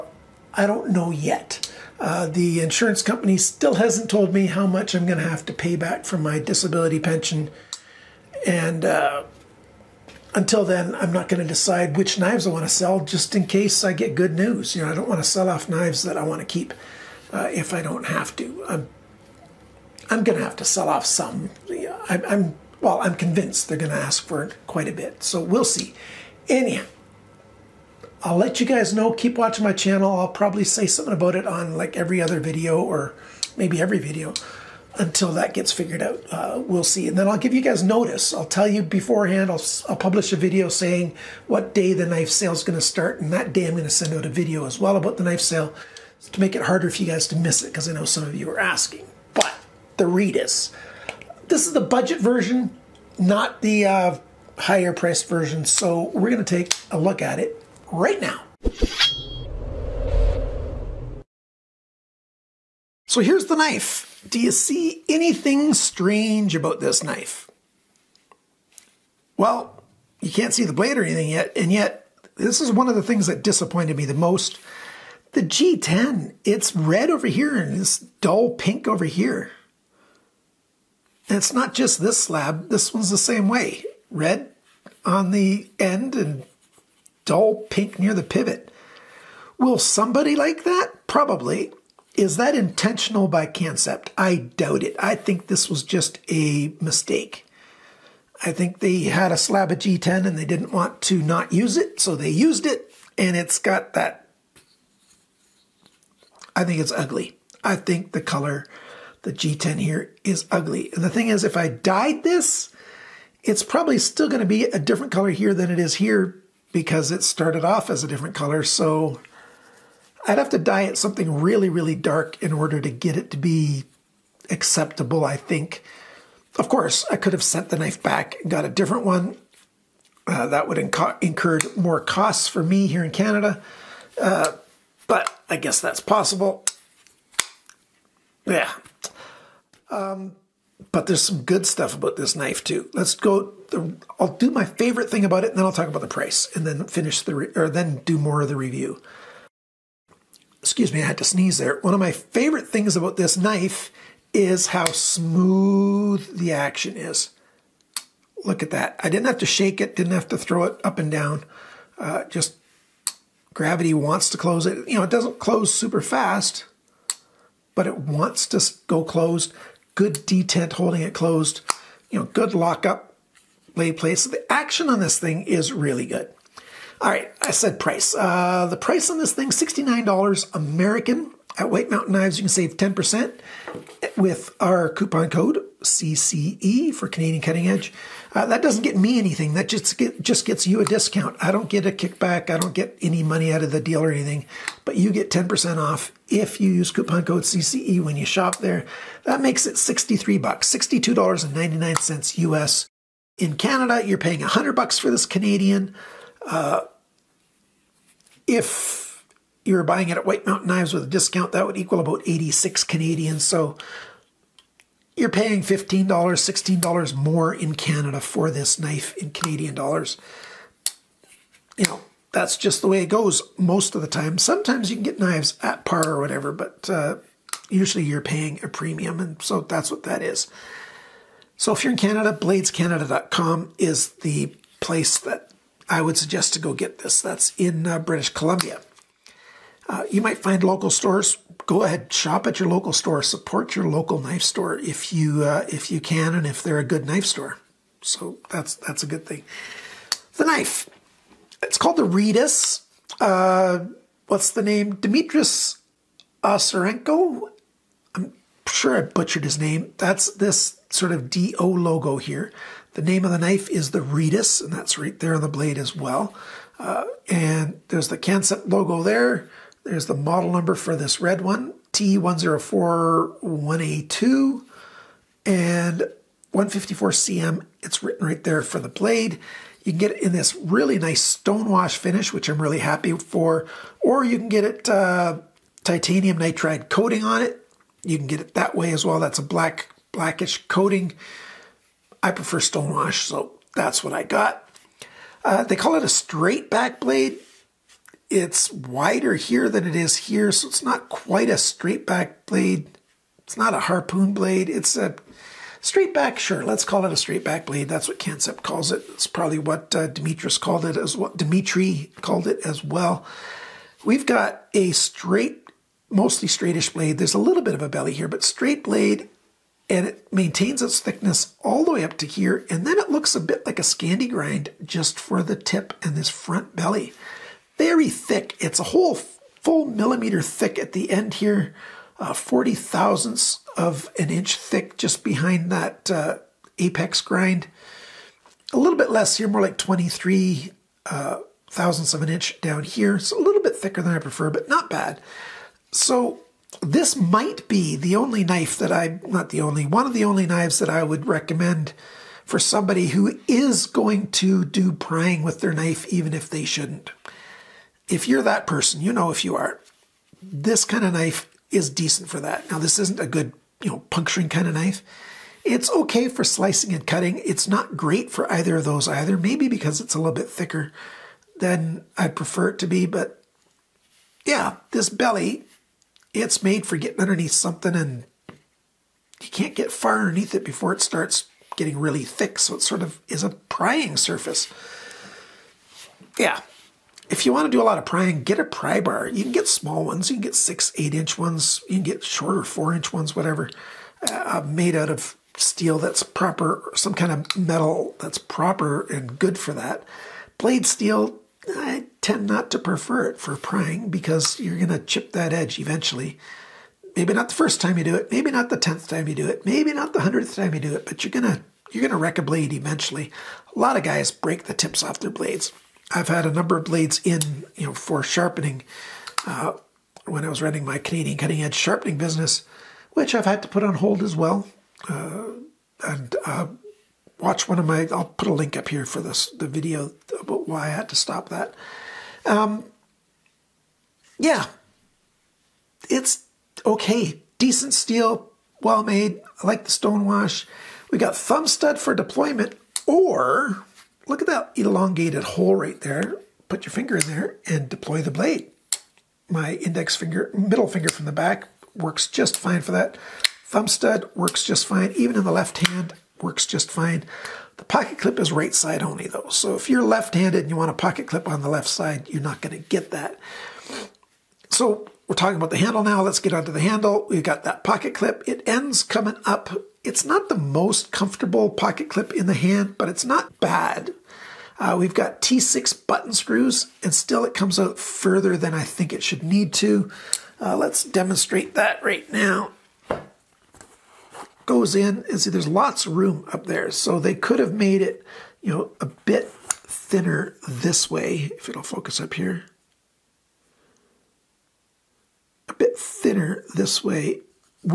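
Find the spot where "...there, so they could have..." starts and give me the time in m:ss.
8:06.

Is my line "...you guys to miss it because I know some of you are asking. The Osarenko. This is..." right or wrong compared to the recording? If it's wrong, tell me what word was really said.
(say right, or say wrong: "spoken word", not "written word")
wrong: "Reedus", not "Osarenko".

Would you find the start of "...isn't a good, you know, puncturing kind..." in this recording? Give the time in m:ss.
6:02.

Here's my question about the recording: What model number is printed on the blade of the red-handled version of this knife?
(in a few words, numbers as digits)
T1041A2.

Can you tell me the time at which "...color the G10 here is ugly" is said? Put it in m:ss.
1:48.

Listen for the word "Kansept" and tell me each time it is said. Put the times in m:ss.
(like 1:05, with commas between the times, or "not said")
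1:33, 4:28, 5:08.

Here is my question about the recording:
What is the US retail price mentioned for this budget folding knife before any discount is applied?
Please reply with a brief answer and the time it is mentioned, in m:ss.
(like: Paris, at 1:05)
$69, at 2:59.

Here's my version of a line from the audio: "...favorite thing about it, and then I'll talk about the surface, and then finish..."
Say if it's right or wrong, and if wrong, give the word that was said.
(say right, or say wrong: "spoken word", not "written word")
wrong: "price", not "surface".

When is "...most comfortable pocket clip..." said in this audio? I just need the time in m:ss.
7:50.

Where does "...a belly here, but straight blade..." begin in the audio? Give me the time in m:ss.
5:17.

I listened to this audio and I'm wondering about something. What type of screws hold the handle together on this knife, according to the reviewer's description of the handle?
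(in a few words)
T6 button screws.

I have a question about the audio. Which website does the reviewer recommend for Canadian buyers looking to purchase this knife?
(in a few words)
bladescanada.com.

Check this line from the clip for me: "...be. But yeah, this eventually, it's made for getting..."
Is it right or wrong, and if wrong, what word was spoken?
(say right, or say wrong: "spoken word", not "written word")
wrong: "belly", not "eventually".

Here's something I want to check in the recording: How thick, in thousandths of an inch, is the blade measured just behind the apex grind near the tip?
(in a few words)
40.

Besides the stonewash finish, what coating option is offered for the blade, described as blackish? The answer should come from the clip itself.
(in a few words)
titanium nitride.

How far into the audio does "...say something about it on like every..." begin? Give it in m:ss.
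0:30.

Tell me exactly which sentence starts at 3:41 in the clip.
You know, that's just the way it goes most of the time.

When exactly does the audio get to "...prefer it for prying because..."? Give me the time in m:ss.
6:42.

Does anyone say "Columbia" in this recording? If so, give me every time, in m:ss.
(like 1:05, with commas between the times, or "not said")
3:58.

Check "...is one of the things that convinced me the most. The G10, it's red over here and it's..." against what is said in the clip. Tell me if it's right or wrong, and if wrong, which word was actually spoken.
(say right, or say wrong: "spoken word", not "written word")
wrong: "disappointed", not "convinced".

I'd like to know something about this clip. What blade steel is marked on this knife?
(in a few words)
154CM.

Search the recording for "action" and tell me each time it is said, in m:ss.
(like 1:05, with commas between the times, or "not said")
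2:36, 2:54.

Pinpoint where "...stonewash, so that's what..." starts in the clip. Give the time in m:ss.
4:52.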